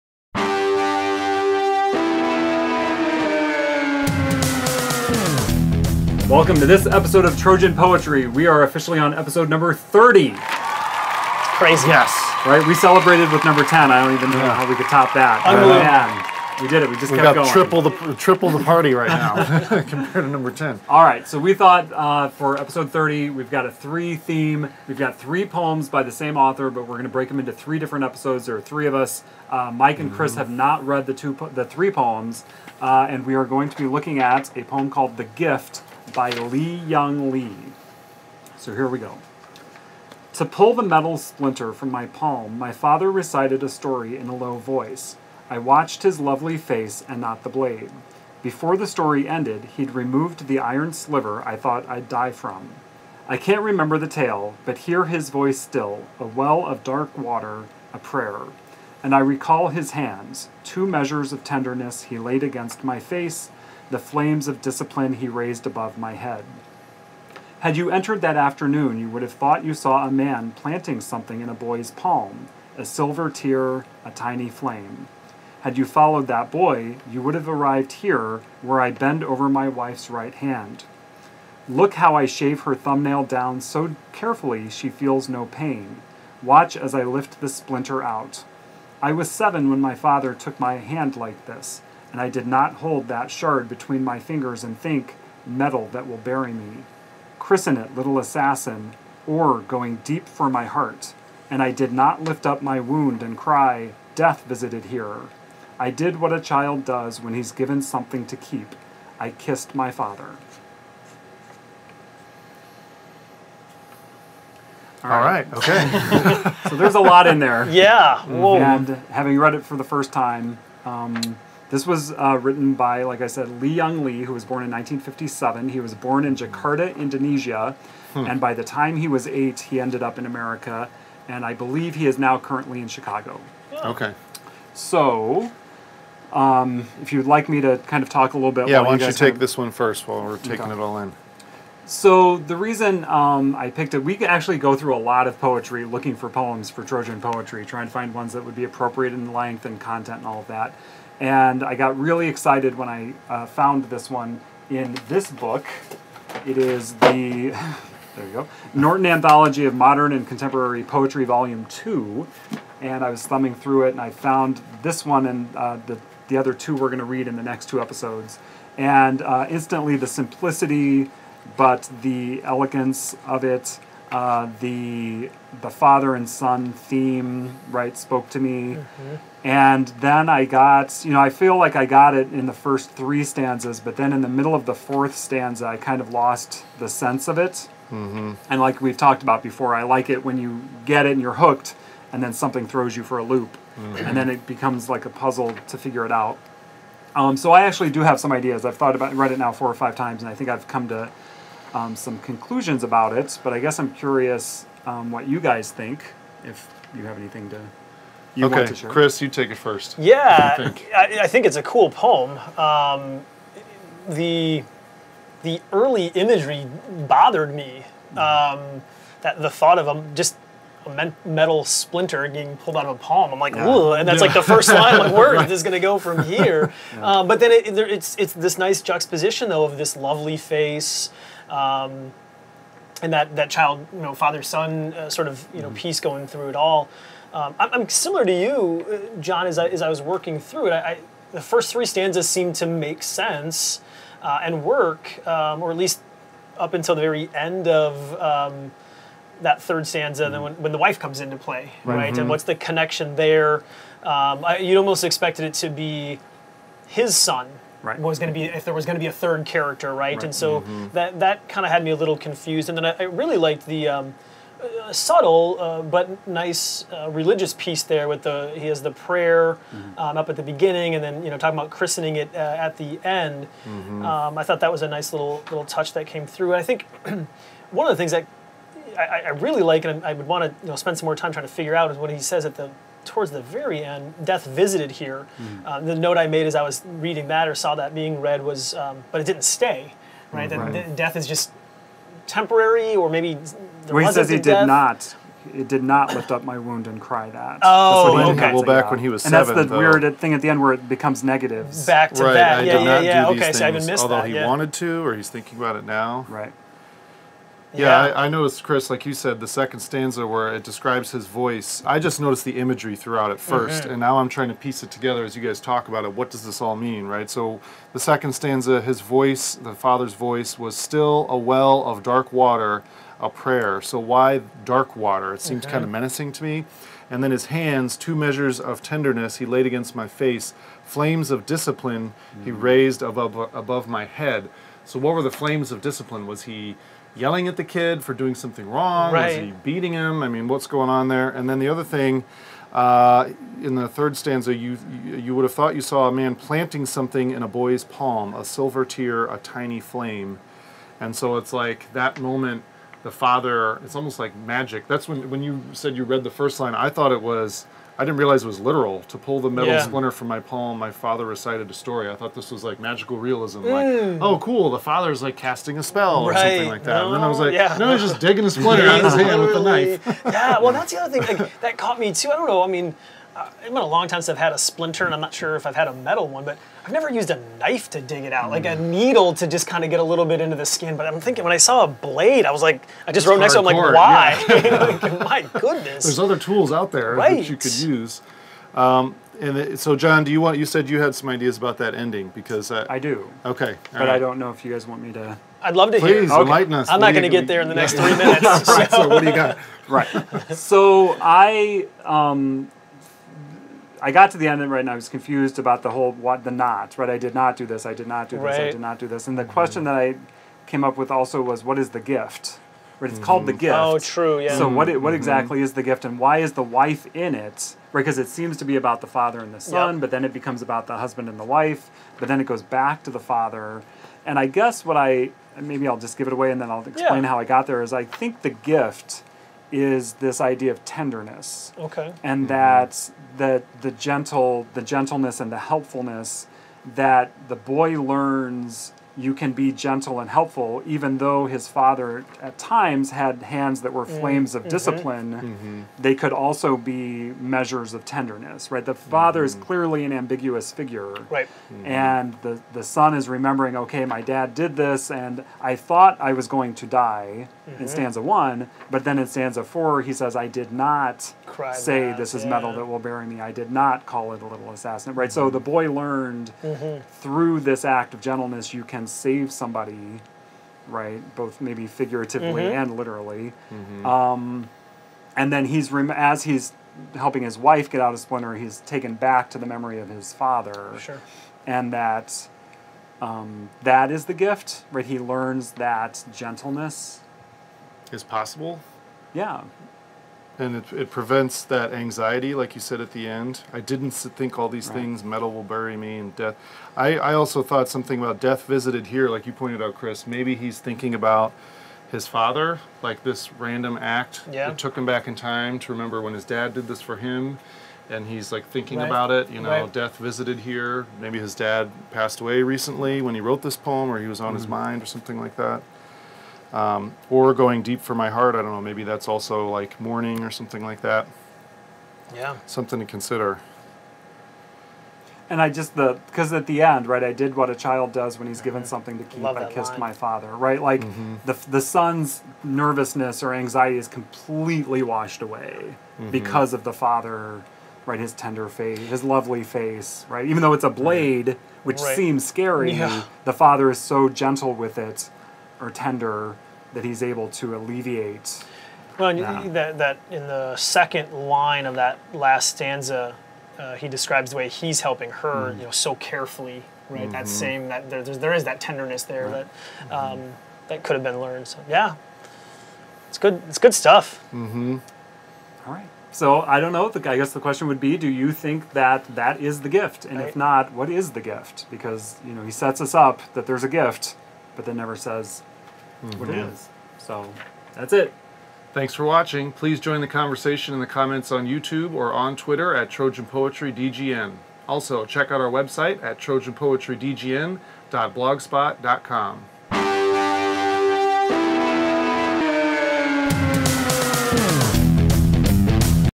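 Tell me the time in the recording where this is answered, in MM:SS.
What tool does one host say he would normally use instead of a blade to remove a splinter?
06:18.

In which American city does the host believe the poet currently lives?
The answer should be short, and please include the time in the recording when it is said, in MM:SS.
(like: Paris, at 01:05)
Chicago, at 02:12.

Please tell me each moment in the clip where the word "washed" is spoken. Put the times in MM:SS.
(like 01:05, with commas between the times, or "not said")
08:55.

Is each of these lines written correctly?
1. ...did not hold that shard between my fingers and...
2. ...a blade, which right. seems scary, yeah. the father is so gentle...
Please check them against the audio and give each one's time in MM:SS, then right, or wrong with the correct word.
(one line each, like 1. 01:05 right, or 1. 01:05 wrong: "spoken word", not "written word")
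1. 01:32 right
2. 09:00 right.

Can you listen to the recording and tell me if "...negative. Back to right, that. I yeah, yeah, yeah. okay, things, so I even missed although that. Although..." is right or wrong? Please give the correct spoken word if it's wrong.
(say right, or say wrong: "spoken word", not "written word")
right.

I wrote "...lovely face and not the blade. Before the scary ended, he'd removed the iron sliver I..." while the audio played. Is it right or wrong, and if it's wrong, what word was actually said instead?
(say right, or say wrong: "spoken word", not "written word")
wrong: "story", not "scary".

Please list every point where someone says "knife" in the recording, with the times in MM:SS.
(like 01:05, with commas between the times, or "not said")
06:09, 06:17.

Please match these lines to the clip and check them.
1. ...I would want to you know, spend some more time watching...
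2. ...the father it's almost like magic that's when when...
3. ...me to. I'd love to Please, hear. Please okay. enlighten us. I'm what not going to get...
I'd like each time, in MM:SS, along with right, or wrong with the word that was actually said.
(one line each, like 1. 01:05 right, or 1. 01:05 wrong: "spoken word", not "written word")
1. 04:40 wrong: "trying", not "watching"
2. 05:53 right
3. 06:35 right.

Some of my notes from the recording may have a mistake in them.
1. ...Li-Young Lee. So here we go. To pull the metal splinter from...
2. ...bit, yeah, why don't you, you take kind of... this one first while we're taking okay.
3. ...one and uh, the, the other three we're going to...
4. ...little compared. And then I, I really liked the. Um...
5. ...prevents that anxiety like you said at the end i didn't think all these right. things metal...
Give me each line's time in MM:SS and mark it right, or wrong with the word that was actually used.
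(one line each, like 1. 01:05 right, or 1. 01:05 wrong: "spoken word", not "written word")
1. 00:36 right
2. 02:18 right
3. 02:45 wrong: "two", not "three"
4. 04:21 wrong: "confused", not "compared"
5. 08:11 right.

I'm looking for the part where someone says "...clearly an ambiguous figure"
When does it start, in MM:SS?
07:29.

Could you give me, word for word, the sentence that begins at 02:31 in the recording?
And I got really excited when I uh, found this one in this book.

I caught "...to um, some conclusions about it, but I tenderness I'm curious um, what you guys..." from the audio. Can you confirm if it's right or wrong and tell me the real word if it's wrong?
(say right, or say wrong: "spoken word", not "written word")
wrong: "guess", not "tenderness".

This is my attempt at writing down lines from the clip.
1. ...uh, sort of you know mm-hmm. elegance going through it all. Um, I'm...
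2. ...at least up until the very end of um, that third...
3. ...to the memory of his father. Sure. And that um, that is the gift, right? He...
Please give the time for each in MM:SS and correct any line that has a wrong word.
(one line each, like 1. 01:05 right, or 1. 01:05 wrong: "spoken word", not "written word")
1. 03:54 wrong: "piece", not "elegance"
2. 04:05 right
3. 07:59 right.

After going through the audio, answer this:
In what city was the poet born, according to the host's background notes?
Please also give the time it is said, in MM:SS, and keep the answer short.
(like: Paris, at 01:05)
Jakarta, at 02:06.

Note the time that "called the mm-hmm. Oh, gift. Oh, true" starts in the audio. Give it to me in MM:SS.
06:53.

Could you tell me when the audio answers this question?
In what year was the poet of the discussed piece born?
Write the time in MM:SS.
02:04.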